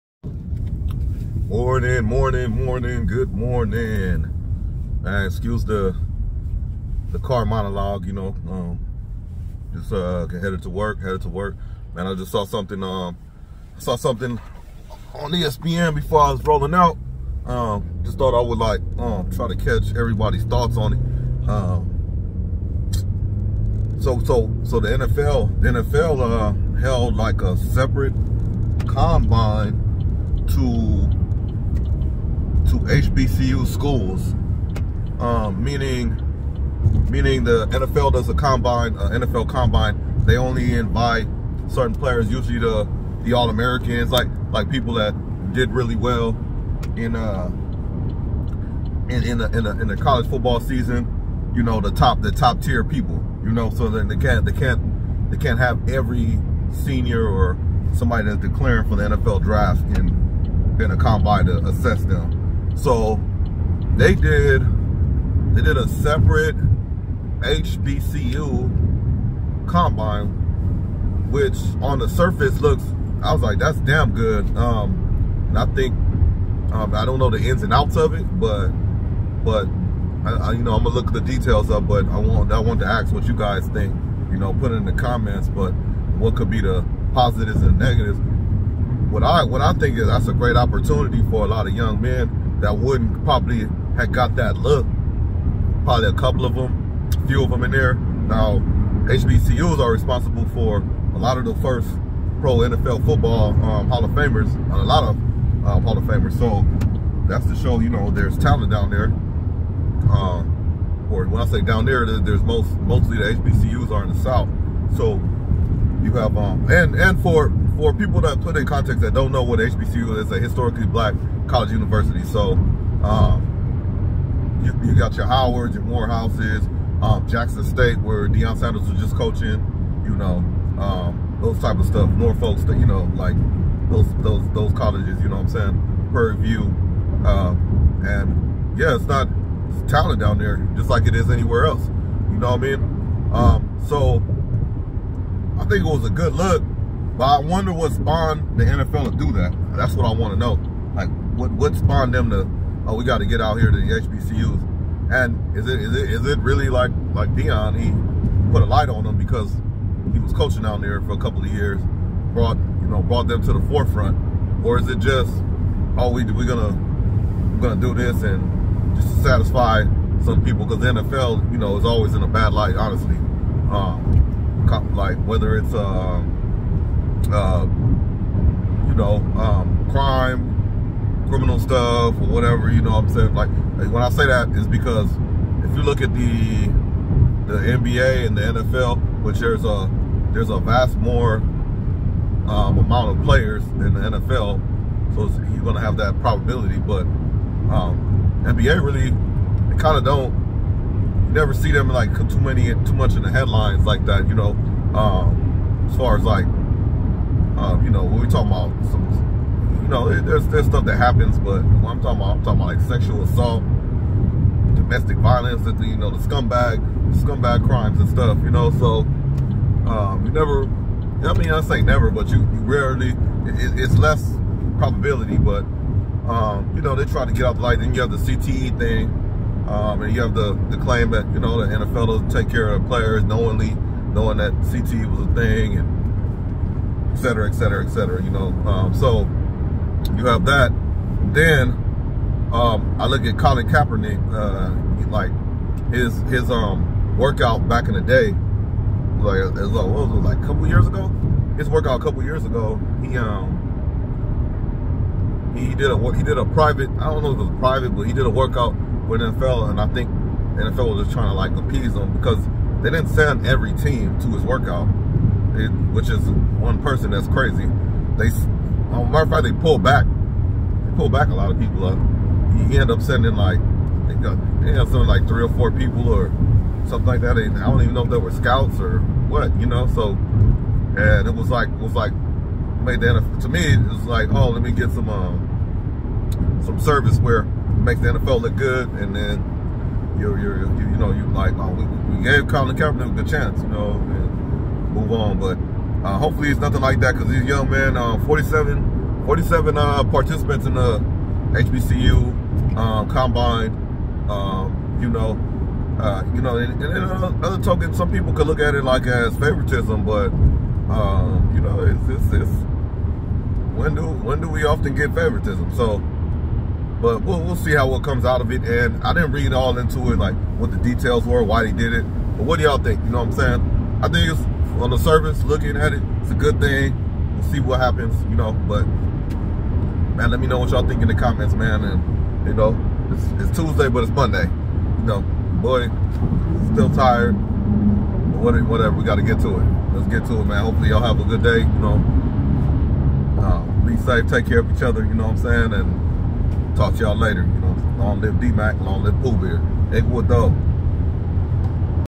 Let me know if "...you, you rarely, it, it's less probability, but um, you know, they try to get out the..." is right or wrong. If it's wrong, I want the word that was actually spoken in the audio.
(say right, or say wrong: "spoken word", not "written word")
right.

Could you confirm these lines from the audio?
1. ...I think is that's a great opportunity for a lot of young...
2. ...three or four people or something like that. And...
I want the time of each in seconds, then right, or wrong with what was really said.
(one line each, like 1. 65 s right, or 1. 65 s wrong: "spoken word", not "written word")
1. 89 s right
2. 275 s right.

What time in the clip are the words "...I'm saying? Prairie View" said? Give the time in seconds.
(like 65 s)
135 s.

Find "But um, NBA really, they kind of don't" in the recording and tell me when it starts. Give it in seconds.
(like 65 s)
196 s.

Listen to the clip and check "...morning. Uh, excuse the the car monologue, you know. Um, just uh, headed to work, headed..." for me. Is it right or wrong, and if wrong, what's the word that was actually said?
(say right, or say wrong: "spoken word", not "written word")
right.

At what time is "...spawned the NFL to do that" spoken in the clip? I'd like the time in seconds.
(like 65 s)
147 s.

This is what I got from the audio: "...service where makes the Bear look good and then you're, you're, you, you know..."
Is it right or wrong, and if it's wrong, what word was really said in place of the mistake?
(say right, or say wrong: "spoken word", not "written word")
wrong: "NFL", not "Bear".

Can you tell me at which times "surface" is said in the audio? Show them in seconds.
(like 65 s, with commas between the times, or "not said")
72 s, 324 s.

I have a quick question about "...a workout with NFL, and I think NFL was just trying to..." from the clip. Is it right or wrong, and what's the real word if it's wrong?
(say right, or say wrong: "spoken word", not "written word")
right.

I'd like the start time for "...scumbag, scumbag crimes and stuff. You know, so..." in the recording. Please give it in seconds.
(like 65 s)
216 s.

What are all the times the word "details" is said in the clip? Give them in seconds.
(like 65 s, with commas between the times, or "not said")
81 s, 320 s.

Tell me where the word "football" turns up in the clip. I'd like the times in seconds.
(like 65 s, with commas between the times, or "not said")
50 s, 103 s.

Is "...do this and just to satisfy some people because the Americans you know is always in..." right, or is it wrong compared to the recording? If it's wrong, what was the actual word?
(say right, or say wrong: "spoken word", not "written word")
wrong: "NFL", not "Americans".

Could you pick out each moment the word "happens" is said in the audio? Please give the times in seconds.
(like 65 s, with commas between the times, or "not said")
210 s, 327 s.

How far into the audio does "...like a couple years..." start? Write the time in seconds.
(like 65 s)
250 s.